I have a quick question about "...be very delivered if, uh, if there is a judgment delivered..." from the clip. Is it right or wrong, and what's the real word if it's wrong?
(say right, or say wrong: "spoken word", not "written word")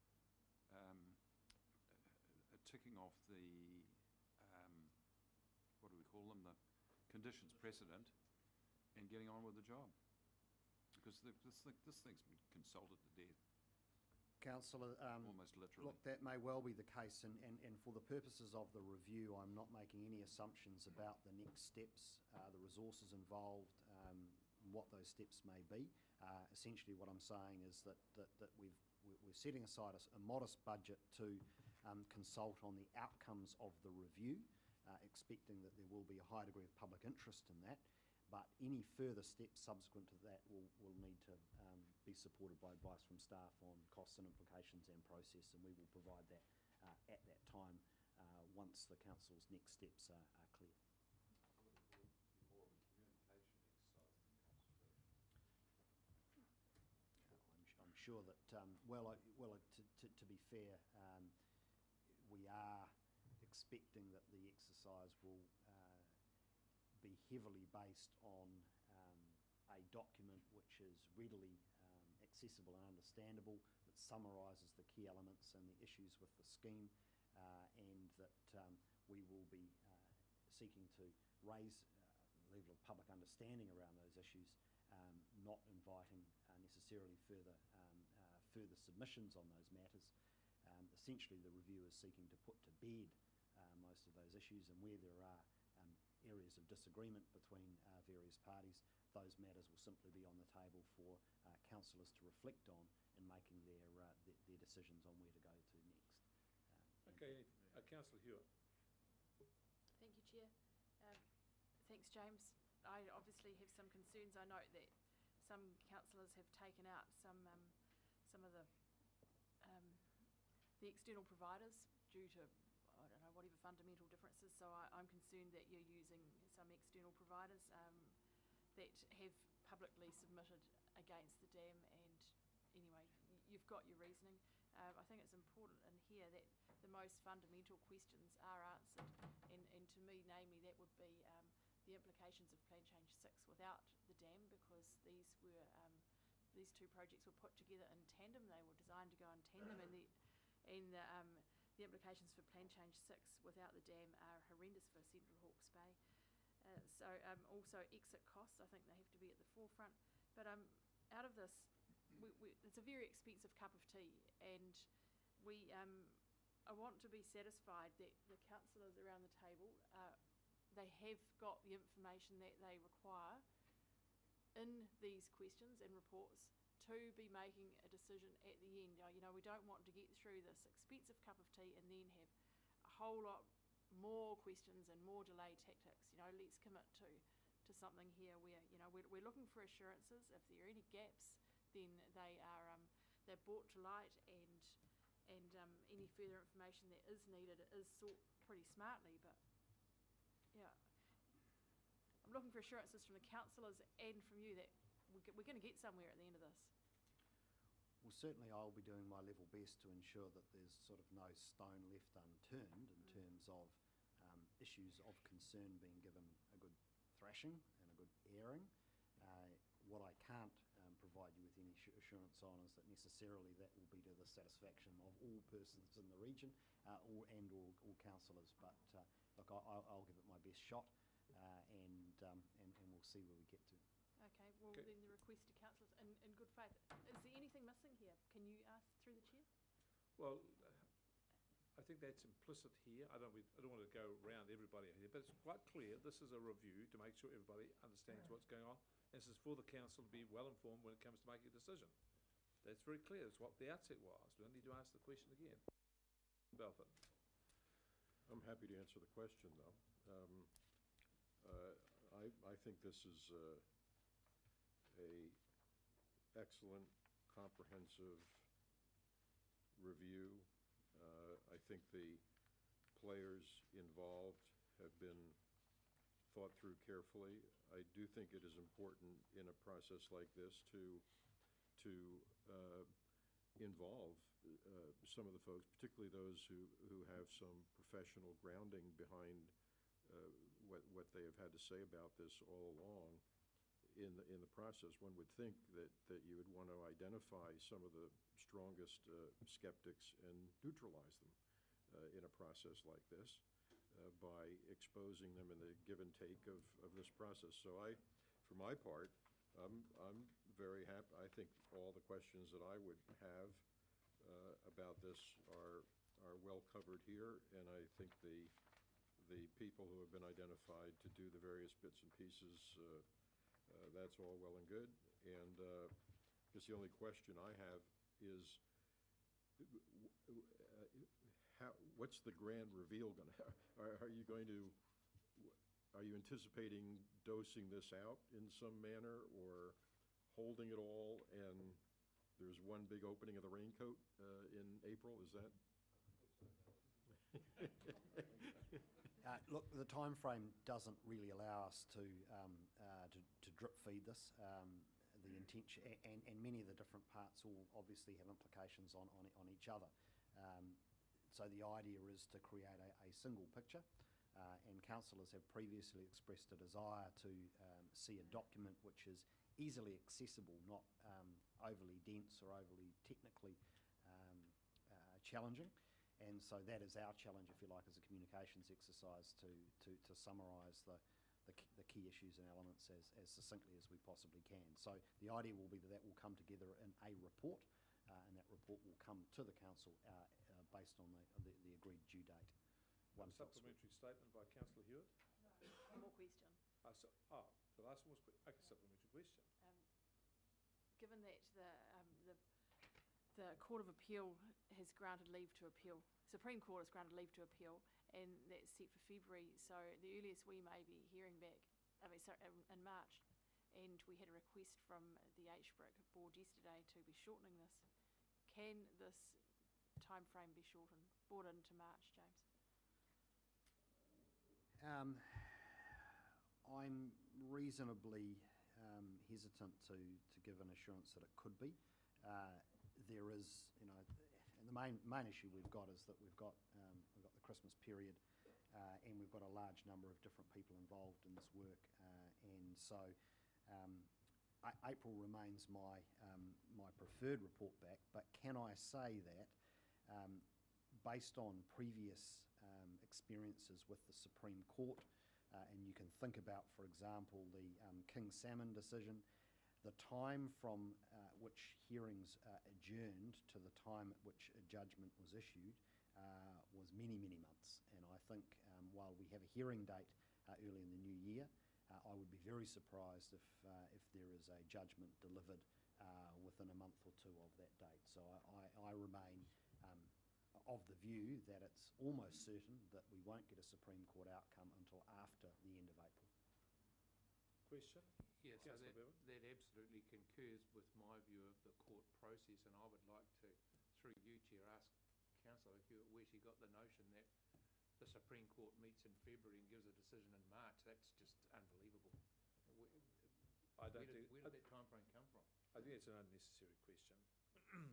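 wrong: "surprised", not "delivered".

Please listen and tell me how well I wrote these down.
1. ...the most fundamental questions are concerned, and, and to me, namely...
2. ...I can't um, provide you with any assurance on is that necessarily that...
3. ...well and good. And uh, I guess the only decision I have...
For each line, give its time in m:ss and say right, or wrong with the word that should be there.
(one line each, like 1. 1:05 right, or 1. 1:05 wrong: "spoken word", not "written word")
1. 2:16 wrong: "answered", not "concerned"
2. 3:40 right
3. 5:24 wrong: "question", not "decision".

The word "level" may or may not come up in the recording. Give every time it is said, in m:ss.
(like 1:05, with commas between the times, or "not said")
1:22, 3:29.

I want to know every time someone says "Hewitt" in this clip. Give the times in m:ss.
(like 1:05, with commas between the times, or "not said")
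1:48, 6:34, 8:15.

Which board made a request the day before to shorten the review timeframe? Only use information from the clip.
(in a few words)
HBRIC board.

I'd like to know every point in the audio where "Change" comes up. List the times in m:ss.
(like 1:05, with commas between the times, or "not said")
2:22, 2:32.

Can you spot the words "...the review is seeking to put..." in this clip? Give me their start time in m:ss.
1:31.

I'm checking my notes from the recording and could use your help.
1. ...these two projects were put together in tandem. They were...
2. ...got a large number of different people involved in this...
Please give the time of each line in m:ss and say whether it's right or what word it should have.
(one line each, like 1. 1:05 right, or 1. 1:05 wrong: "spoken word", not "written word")
1. 2:26 right
2. 7:19 right.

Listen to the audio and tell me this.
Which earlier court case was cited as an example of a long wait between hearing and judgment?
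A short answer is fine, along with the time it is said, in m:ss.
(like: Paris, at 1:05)
King Salmon, at 7:38.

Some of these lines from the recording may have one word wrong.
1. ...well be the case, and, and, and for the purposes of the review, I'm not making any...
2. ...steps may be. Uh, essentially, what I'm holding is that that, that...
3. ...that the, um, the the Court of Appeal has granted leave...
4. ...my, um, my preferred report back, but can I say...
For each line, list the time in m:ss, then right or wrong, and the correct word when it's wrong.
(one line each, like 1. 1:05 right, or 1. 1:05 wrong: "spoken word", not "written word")
1. 0:16 right
2. 0:25 wrong: "saying", not "holding"
3. 6:41 right
4. 7:25 right.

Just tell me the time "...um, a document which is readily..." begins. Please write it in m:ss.
1:08.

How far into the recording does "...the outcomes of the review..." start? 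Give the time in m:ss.
0:32.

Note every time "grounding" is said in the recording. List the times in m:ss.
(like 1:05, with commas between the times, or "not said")
4:48.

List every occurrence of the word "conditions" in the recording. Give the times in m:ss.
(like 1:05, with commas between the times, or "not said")
0:07.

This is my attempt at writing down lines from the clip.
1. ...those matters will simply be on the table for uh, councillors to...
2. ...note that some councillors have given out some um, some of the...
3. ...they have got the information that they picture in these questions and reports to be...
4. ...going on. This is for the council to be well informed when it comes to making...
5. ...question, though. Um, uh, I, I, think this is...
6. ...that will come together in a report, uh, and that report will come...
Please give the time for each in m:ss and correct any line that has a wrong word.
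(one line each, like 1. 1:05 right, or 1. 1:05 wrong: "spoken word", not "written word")
1. 1:39 right
2. 1:54 wrong: "taken", not "given"
3. 2:50 wrong: "require", not "picture"
4. 4:08 right
5. 4:19 right
6. 6:25 right.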